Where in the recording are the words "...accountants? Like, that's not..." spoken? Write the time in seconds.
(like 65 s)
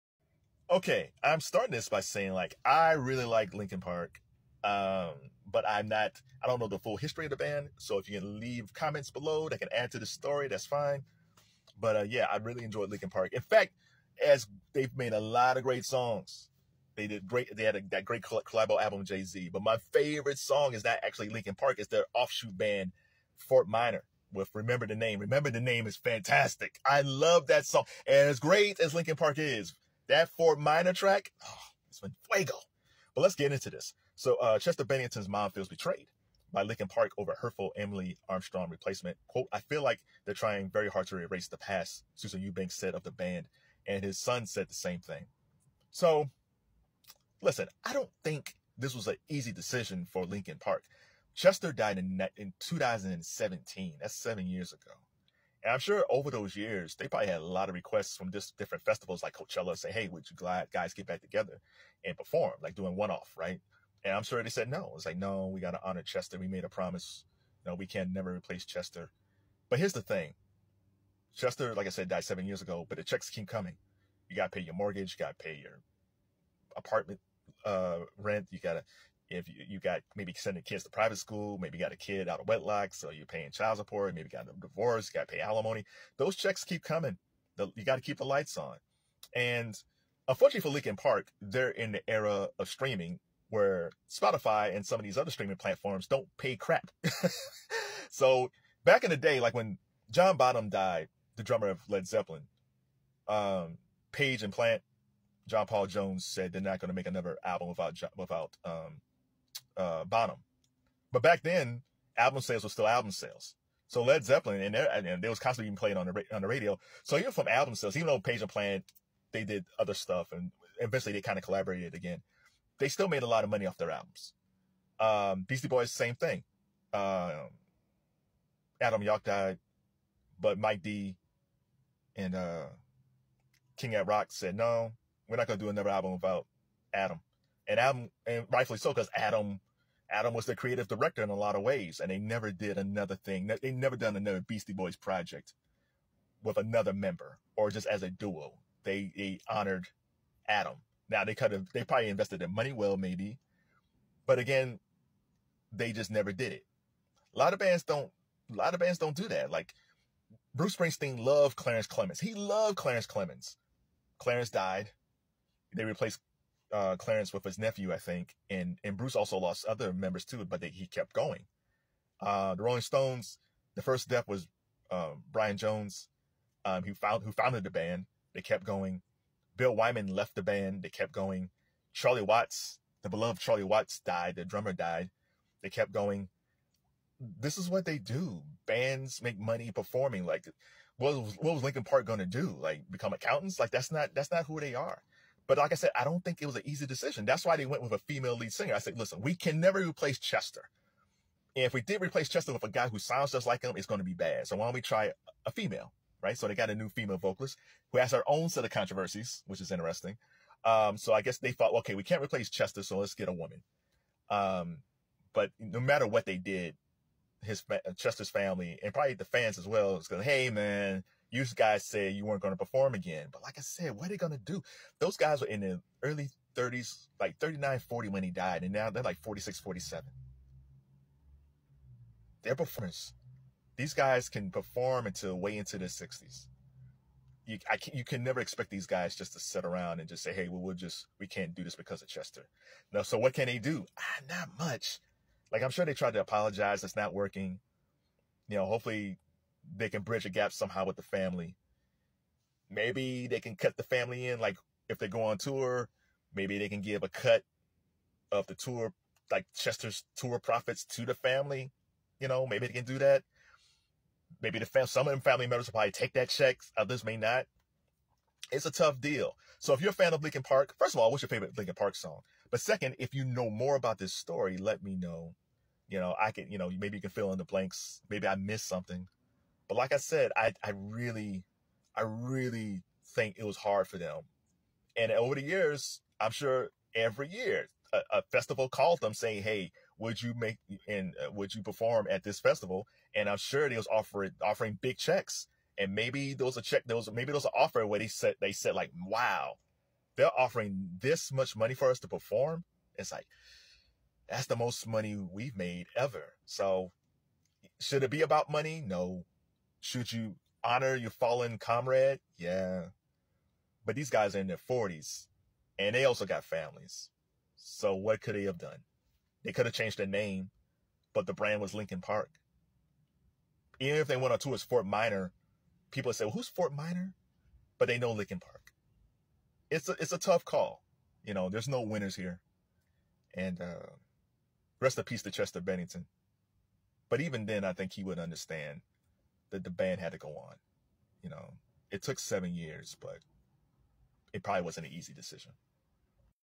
193 s.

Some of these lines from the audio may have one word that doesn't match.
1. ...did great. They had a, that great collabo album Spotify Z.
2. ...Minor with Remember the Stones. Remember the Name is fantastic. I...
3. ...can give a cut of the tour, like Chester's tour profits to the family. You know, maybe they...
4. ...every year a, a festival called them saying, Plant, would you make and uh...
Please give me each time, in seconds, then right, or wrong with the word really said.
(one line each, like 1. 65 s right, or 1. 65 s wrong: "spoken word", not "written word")
1. 17 s wrong: "Jay", not "Spotify"
2. 23 s wrong: "Name", not "Stones"
3. 256 s right
4. 286 s wrong: "Hey", not "Plant".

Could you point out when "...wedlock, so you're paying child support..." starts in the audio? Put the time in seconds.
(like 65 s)
82 s.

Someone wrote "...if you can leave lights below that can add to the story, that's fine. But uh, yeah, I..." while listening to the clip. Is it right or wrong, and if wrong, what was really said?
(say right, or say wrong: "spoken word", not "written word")
wrong: "comments", not "lights".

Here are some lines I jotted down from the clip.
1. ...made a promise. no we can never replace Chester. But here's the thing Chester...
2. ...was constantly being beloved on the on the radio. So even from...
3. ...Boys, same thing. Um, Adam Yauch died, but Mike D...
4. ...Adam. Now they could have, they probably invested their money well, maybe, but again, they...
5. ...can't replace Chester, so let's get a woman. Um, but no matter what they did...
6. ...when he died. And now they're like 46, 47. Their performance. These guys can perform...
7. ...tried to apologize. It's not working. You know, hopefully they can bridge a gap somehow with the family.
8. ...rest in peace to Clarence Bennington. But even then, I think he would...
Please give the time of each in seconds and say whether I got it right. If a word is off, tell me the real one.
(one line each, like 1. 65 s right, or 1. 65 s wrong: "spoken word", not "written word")
1. 66 s right
2. 115 s wrong: "played", not "beloved"
3. 125 s right
4. 150 s right
5. 212 s right
6. 228 s right
7. 245 s right
8. 334 s wrong: "Chester", not "Clarence".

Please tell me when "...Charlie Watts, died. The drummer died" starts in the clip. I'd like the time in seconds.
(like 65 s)
183 s.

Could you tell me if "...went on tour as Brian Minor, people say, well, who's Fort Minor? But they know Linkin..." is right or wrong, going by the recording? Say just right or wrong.
wrong.